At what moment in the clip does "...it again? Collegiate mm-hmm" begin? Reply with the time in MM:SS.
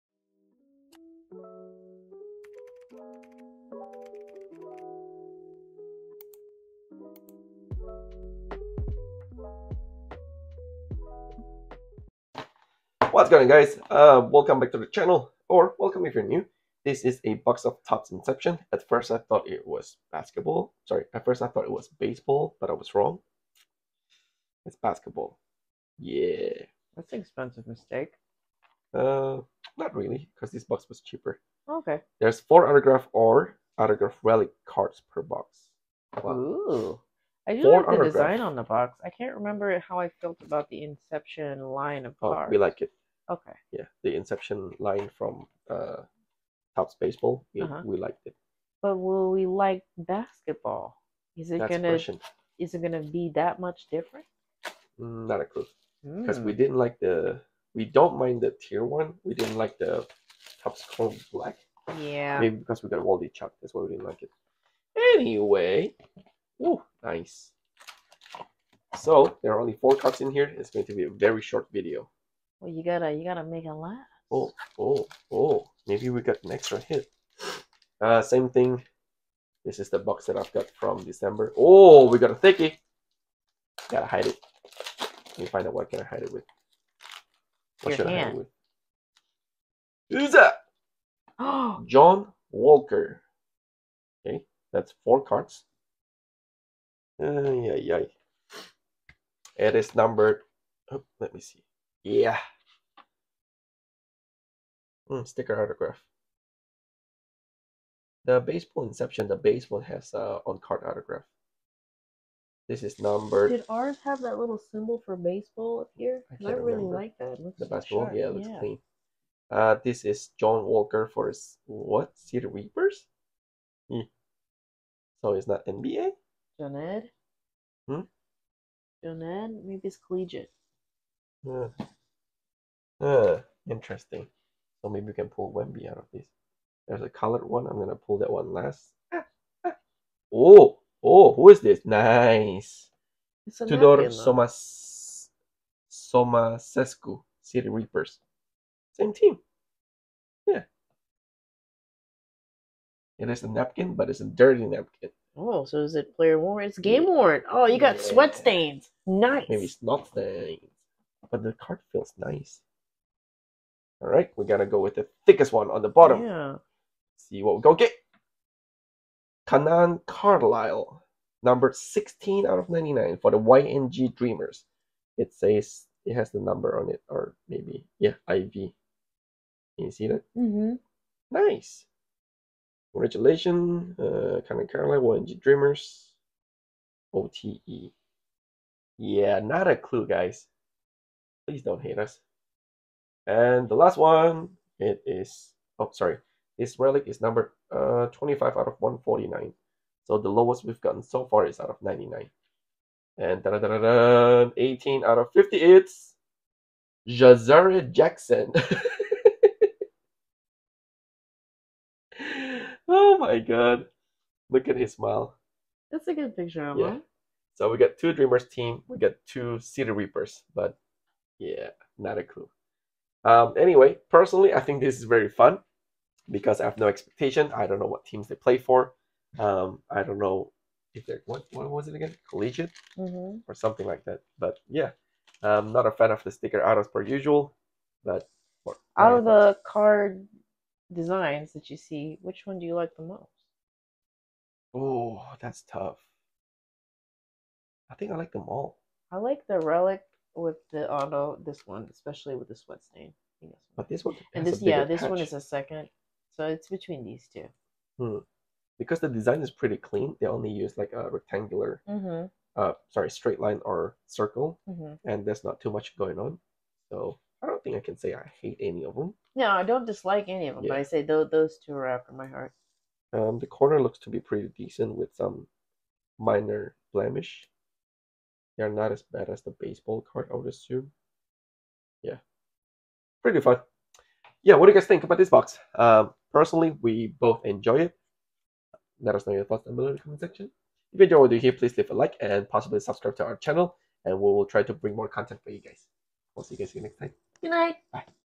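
03:51.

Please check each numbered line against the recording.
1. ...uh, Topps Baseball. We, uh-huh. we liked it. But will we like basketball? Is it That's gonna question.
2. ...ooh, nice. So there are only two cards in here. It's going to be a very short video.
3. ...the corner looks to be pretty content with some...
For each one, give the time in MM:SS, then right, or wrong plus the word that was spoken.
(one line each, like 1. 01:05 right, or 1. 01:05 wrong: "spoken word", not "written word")
1. 00:45 right
2. 01:06 wrong: "four", not "two"
3. 04:33 wrong: "decent", not "content".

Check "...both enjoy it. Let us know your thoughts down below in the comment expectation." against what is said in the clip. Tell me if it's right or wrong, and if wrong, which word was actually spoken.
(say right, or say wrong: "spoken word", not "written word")
wrong: "section", not "expectation".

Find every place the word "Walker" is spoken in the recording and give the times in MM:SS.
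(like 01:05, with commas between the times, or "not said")
01:32, 02:00.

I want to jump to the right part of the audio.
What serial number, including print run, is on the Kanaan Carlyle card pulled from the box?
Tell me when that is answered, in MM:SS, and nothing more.
02:51.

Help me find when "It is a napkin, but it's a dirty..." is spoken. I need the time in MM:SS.
02:33.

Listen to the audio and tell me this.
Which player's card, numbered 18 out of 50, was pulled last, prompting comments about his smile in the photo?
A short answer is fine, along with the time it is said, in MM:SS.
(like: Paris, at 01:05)
Jazari Jackson, at 03:27.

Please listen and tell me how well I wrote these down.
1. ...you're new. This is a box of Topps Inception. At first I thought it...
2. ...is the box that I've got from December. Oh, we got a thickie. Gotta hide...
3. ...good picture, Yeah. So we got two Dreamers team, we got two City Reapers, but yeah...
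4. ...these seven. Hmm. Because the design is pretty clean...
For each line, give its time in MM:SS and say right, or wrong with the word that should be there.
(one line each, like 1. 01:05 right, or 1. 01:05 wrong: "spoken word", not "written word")
1. 00:16 right
2. 01:19 right
3. 03:36 right
4. 04:17 wrong: "two", not "seven".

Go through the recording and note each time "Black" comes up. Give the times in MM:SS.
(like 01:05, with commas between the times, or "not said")
01:01.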